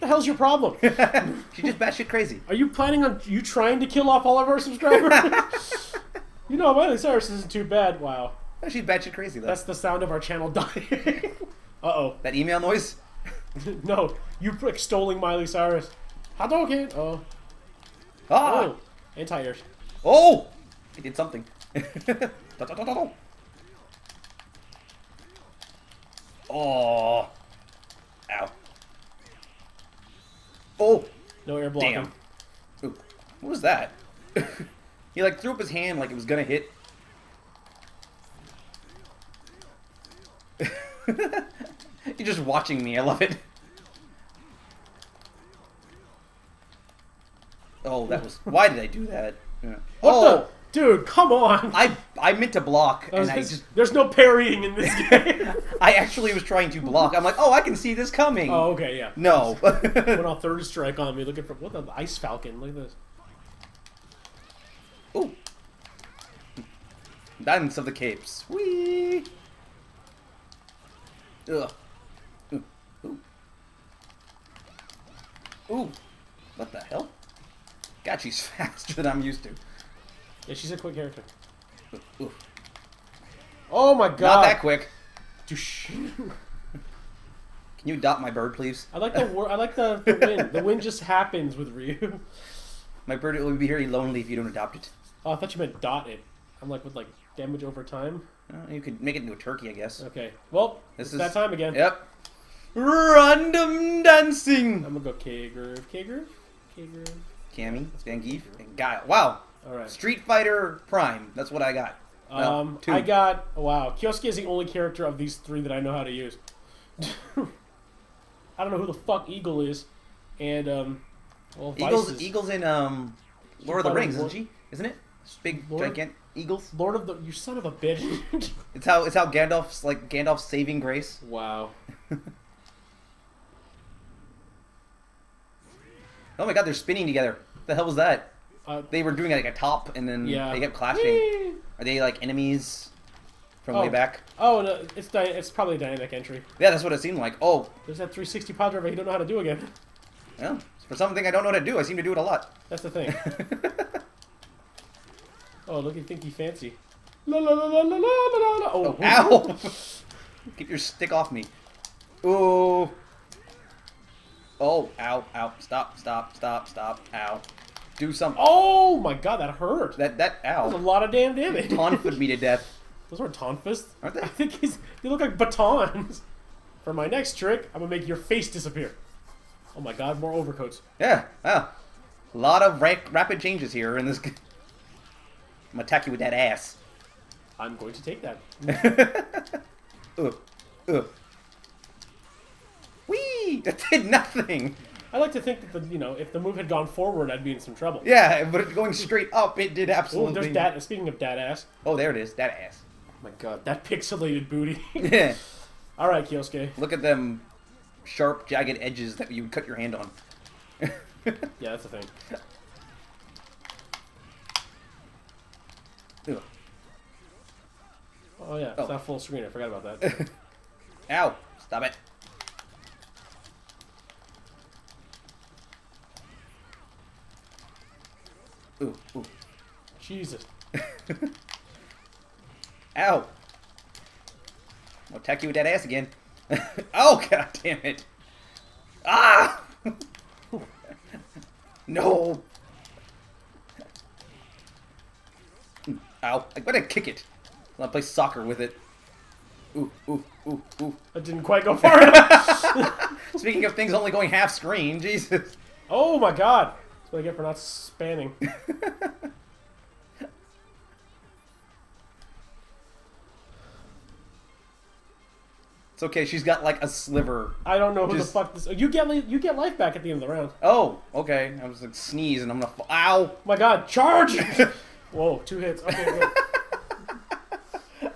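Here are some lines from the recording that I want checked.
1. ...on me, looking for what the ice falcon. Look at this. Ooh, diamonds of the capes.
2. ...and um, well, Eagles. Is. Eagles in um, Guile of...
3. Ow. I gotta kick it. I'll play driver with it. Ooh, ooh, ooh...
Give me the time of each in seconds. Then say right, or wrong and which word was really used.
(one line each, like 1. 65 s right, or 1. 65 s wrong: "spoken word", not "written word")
1. 60 s right
2. 120 s wrong: "Lord", not "Guile"
3. 246 s wrong: "soccer", not "driver".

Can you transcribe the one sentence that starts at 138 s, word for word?
Uh, they were doing like a top, and then yeah.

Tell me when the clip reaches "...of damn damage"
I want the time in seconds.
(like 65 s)
171 s.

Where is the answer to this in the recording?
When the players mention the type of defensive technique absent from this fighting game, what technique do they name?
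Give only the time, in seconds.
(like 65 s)
54 s.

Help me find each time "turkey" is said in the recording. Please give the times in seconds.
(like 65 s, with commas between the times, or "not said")
99 s.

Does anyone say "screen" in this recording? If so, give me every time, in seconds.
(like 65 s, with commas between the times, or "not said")
219 s, 254 s.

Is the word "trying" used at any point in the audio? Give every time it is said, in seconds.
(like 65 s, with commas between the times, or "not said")
3 s, 56 s.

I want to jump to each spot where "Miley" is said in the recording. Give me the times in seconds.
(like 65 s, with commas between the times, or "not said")
6 s, 15 s.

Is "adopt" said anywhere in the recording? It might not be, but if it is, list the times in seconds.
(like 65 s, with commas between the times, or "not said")
87 s, 94 s.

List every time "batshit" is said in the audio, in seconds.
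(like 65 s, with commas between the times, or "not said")
1 s, 8 s.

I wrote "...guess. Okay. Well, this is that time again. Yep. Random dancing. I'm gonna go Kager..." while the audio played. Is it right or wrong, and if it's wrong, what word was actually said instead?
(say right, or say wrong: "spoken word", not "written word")
right.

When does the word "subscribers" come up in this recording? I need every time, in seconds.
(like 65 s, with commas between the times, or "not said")
4 s.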